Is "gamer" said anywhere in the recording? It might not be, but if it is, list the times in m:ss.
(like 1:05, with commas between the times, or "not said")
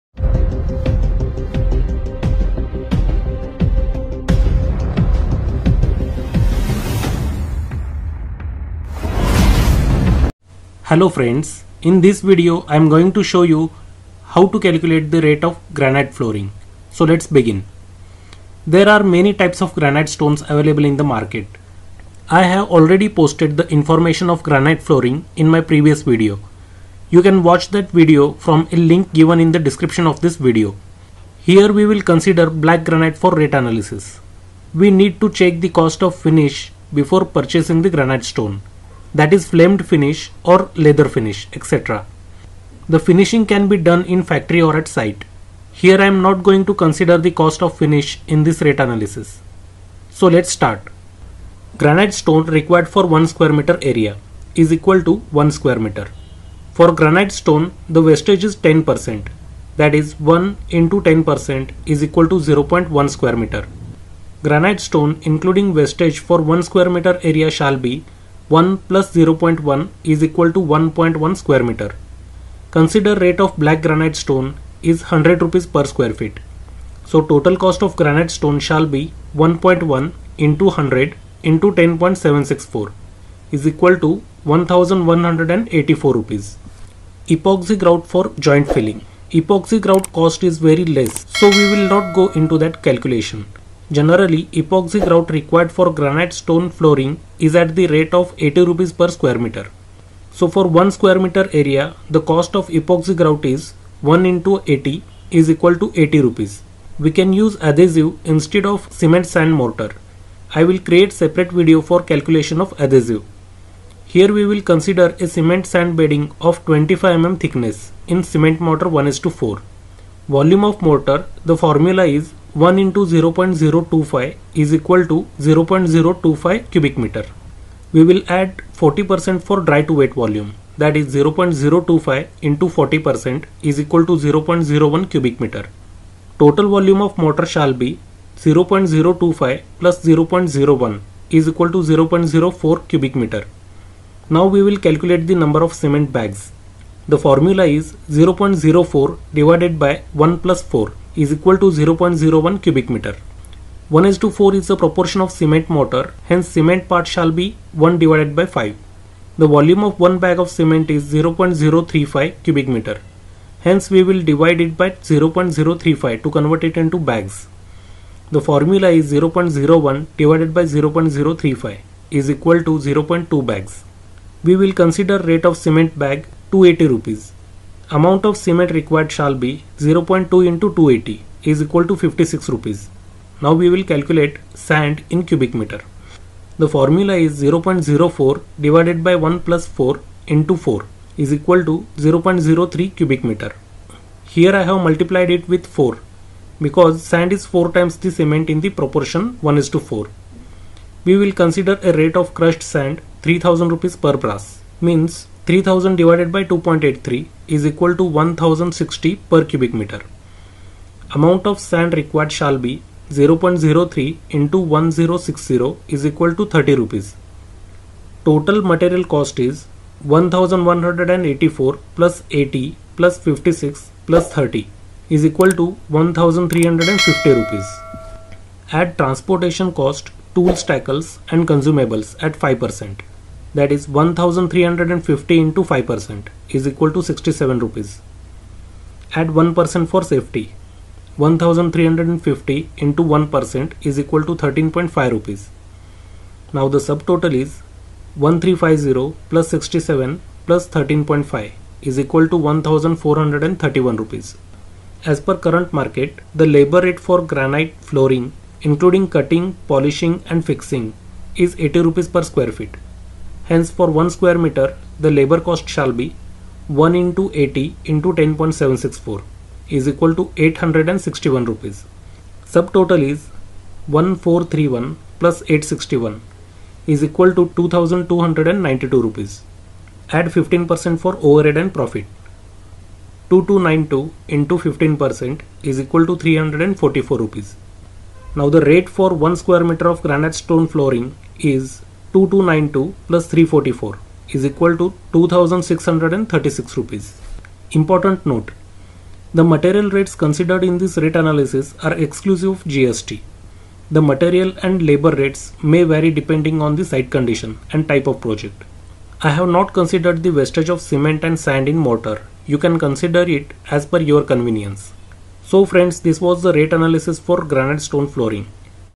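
not said.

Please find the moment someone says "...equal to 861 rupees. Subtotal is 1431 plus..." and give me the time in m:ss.
4:29.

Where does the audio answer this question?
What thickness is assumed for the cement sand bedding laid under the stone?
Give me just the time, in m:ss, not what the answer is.
1:56.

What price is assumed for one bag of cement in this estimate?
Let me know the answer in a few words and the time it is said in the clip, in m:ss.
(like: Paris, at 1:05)
280 rupees, at 2:56.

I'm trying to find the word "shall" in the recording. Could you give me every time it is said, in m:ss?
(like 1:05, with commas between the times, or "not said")
1:07, 1:18, 2:17, 2:37, 2:59, 3:32, 4:25.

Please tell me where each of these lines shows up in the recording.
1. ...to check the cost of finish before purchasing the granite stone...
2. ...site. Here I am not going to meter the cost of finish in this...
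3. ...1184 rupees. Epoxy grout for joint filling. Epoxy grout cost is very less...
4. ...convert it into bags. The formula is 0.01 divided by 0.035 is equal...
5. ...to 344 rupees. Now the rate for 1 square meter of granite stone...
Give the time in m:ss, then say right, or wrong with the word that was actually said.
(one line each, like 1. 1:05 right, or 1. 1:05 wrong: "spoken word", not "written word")
1. 0:35 right
2. 0:44 wrong: "consider", not "meter"
3. 1:24 right
4. 2:46 right
5. 4:46 right.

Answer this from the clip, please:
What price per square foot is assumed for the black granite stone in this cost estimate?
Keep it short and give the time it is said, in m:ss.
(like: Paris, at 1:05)
100 rupees, at 1:15.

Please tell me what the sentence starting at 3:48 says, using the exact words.
Add transportation cost, tool tackles and consumables at 5%.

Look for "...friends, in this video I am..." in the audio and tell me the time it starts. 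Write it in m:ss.
0:11.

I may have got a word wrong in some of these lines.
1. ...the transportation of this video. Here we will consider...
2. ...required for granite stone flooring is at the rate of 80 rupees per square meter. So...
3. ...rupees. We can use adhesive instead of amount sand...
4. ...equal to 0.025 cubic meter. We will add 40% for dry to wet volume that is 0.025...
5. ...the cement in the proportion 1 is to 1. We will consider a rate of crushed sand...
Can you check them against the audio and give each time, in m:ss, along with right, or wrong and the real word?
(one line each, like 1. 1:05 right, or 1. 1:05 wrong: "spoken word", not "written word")
1. 0:29 wrong: "description", not "transportation"
2. 1:35 right
3. 1:46 wrong: "cement", not "amount"
4. 2:04 right
5. 3:17 wrong: "4", not "1".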